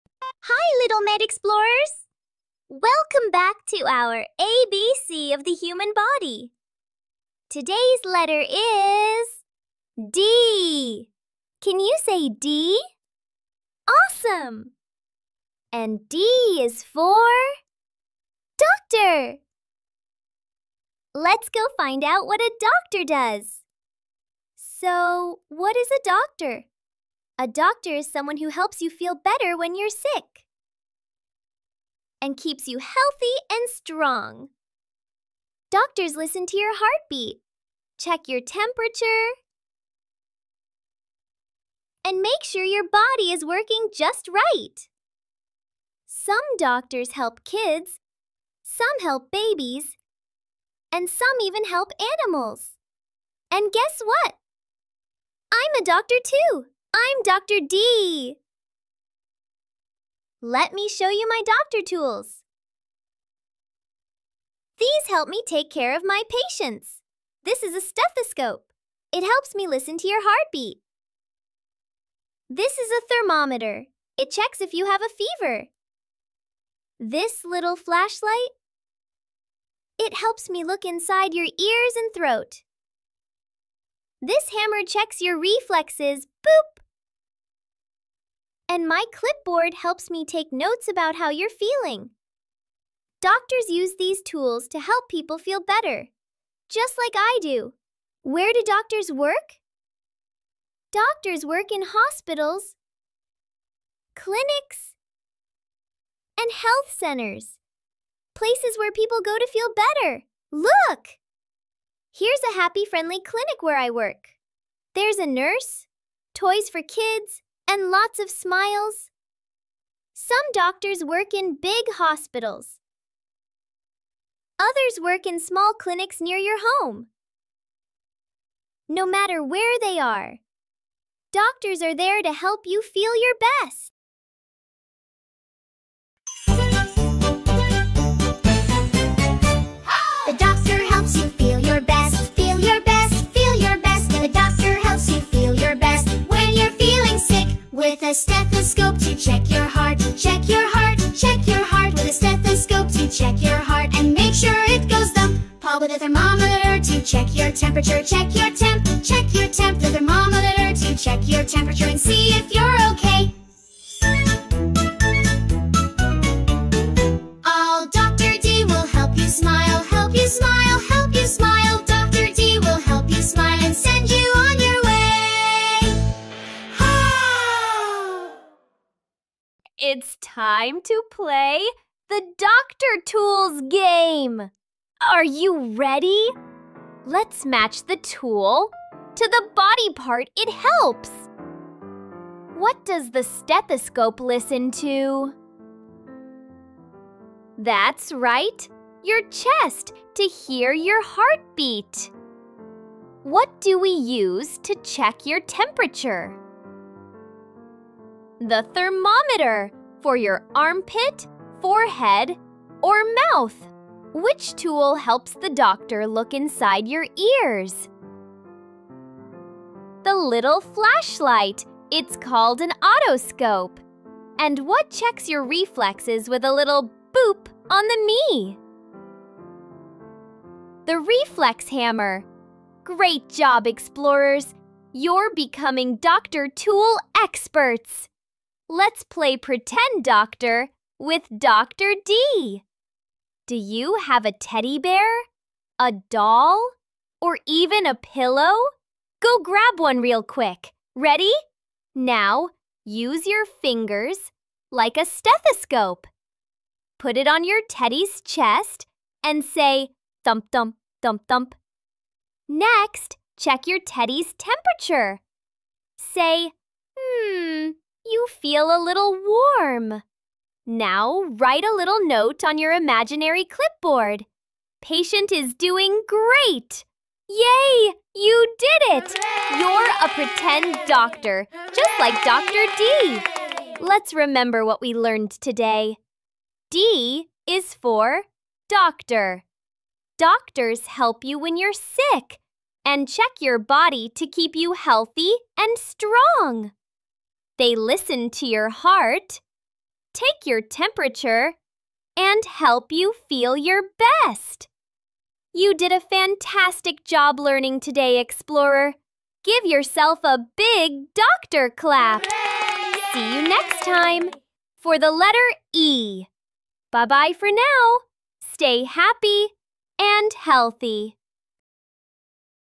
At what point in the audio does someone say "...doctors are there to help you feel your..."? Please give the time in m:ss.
2:11.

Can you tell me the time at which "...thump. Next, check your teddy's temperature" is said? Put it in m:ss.
4:21.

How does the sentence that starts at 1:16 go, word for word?
This little flashlight, it helps me look inside your ears and throat.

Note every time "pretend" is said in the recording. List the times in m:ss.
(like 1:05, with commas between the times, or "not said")
3:59, 4:40.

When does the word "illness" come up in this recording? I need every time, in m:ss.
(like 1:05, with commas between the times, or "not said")
not said.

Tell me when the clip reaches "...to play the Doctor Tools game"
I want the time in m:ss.
3:00.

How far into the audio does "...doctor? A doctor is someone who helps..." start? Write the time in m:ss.
0:26.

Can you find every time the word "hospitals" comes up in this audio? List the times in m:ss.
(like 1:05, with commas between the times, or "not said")
1:41, 2:01.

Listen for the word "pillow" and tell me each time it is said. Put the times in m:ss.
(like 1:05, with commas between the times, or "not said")
4:07.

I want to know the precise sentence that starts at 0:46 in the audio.
Some doctors help kids, some help babies, and some even help animals.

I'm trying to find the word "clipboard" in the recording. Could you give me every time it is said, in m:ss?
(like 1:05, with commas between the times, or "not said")
1:29, 4:33.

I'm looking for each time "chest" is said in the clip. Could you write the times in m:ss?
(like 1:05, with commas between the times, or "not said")
3:19, 4:18.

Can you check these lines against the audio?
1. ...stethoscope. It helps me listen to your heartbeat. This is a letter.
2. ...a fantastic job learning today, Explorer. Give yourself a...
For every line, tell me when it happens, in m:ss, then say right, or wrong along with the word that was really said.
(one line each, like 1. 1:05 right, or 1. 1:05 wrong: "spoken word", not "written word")
1. 1:07 wrong: "thermometer", not "letter"
2. 5:05 right.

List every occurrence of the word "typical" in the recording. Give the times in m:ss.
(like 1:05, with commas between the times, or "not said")
not said.